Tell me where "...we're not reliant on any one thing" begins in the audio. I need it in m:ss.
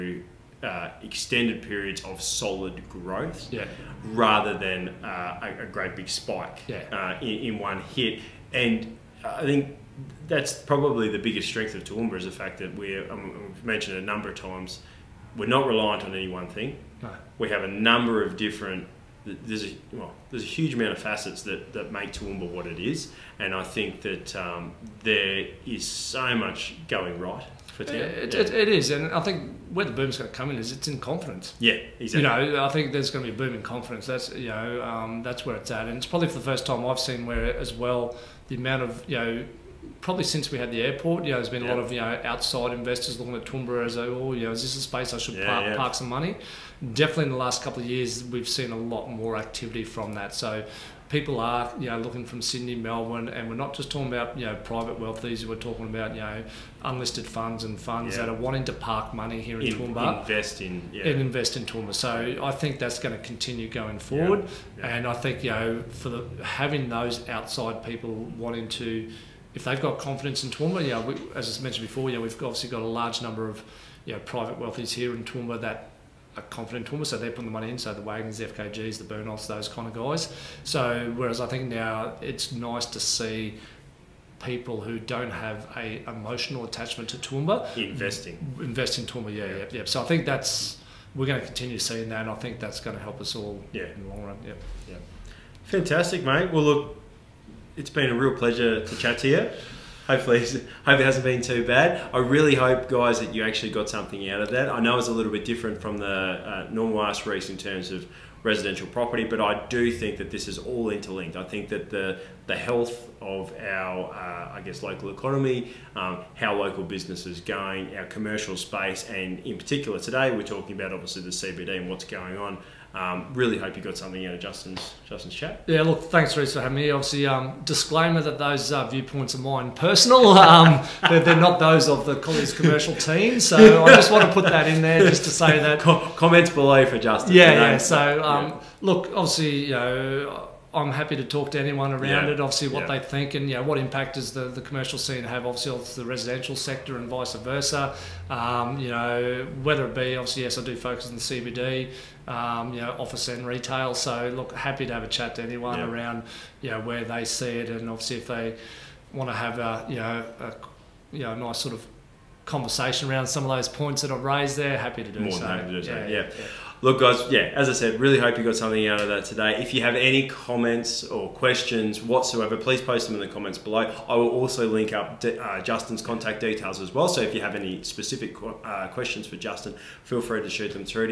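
0:15.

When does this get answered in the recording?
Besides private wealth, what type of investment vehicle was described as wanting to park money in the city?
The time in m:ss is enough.
0:56.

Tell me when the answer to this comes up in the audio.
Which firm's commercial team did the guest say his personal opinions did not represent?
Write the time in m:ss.
2:12.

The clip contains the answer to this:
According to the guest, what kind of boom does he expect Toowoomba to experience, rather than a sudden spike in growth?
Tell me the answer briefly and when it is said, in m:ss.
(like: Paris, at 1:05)
A boom in confidence, at 0:33.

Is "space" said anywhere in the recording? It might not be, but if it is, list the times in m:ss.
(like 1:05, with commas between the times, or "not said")
0:44, 1:58.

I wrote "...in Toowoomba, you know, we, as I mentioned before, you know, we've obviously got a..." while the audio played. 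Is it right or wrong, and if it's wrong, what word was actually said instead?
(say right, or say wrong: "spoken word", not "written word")
right.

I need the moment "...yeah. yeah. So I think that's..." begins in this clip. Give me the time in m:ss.
1:29.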